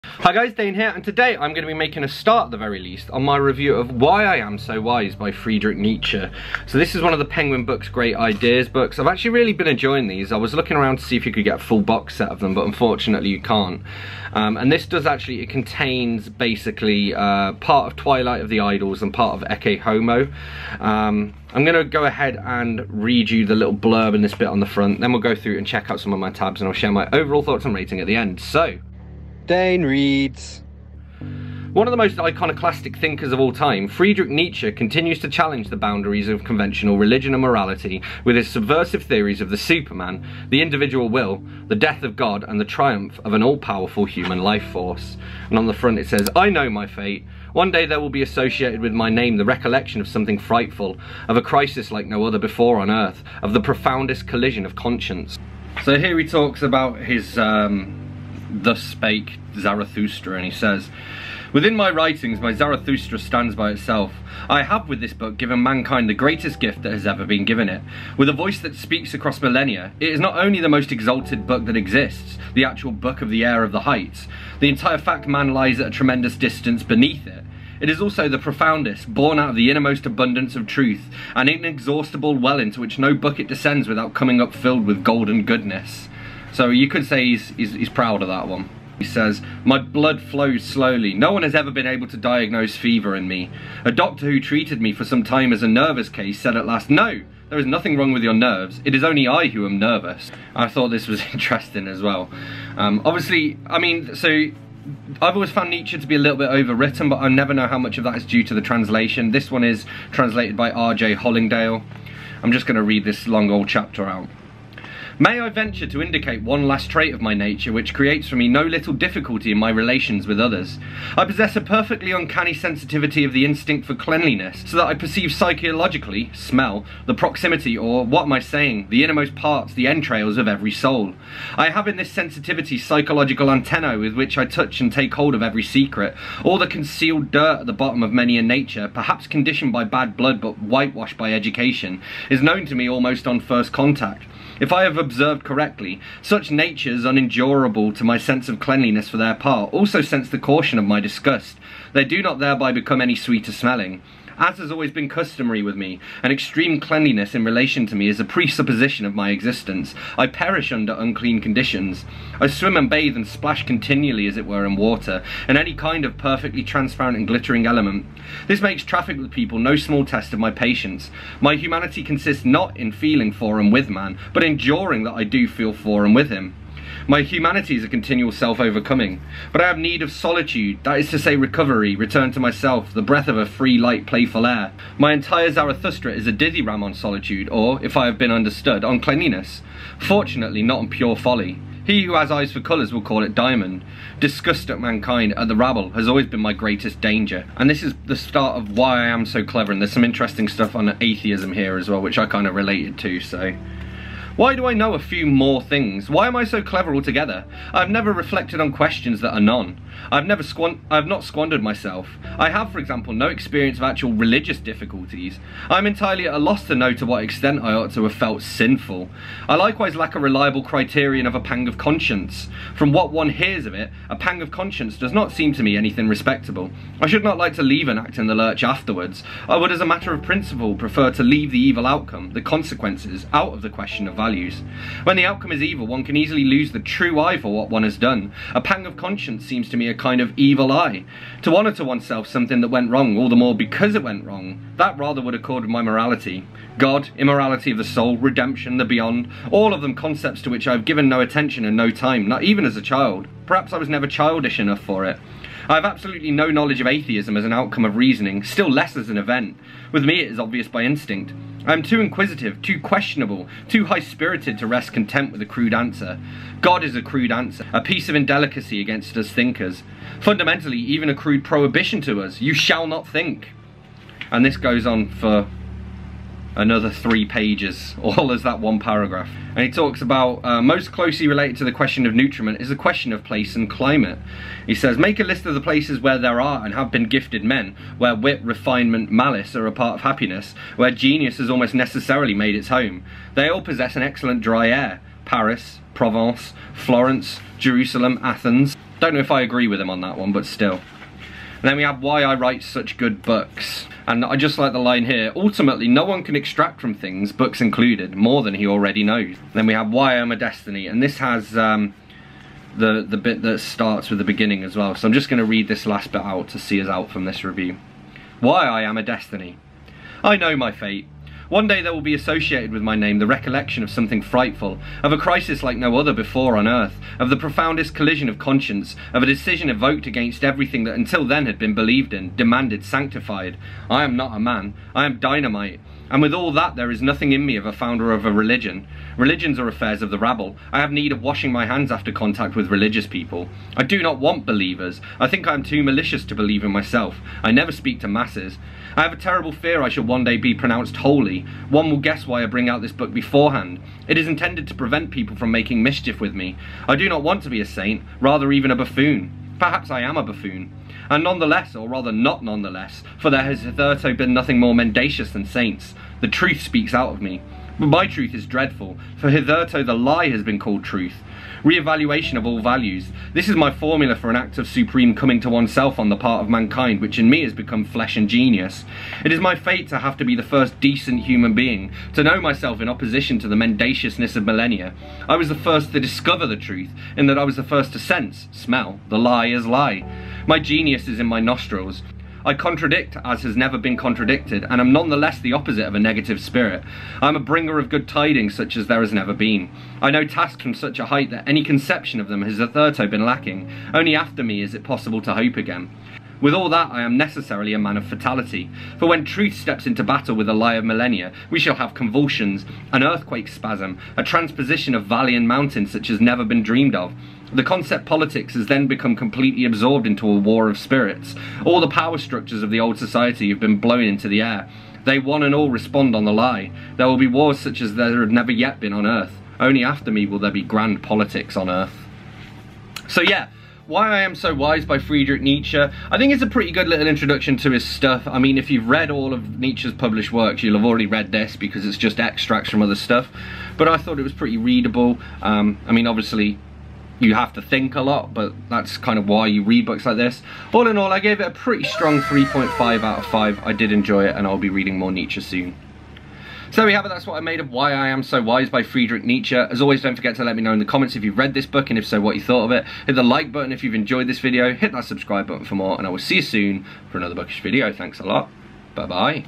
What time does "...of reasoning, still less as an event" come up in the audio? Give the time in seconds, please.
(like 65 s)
257 s.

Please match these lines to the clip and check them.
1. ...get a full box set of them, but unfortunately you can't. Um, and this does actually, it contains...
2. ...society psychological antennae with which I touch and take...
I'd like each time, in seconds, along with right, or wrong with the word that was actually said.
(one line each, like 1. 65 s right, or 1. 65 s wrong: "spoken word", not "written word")
1. 11 s right
2. 132 s wrong: "sensitivity", not "society".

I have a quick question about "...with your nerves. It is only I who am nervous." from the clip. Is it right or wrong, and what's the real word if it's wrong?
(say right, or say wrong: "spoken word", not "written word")
right.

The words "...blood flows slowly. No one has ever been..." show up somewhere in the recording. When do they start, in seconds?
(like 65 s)
89 s.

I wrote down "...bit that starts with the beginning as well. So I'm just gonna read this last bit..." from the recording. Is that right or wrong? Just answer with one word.
right.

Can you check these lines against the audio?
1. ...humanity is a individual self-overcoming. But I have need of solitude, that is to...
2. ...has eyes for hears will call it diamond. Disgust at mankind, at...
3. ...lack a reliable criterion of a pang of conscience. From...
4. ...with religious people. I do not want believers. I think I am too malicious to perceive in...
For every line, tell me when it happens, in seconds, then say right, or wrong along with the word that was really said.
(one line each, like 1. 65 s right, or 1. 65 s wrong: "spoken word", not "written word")
1. 177 s wrong: "continual", not "individual"
2. 192 s wrong: "colours", not "hears"
3. 219 s right
4. 342 s wrong: "believe", not "perceive".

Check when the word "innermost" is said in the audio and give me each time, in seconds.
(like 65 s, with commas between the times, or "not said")
79 s, 129 s.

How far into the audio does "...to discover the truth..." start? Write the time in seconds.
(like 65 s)
385 s.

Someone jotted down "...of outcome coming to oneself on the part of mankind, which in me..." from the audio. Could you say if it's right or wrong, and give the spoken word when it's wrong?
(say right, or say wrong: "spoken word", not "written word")
wrong: "supreme", not "outcome".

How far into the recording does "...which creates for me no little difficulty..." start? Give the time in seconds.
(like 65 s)
117 s.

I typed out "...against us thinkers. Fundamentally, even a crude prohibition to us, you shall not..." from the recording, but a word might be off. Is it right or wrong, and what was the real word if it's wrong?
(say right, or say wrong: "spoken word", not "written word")
right.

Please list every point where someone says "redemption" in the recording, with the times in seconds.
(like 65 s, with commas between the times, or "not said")
248 s.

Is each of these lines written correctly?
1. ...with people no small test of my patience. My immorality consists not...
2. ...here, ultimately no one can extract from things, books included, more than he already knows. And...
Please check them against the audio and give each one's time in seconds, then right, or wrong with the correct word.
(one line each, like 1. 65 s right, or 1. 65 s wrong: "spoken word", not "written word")
1. 169 s wrong: "humanity", not "immorality"
2. 305 s right.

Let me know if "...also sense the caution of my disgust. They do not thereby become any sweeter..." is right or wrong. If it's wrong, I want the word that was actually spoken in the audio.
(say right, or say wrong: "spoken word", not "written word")
right.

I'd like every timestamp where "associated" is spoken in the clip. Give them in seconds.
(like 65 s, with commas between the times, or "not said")
48 s, 322 s.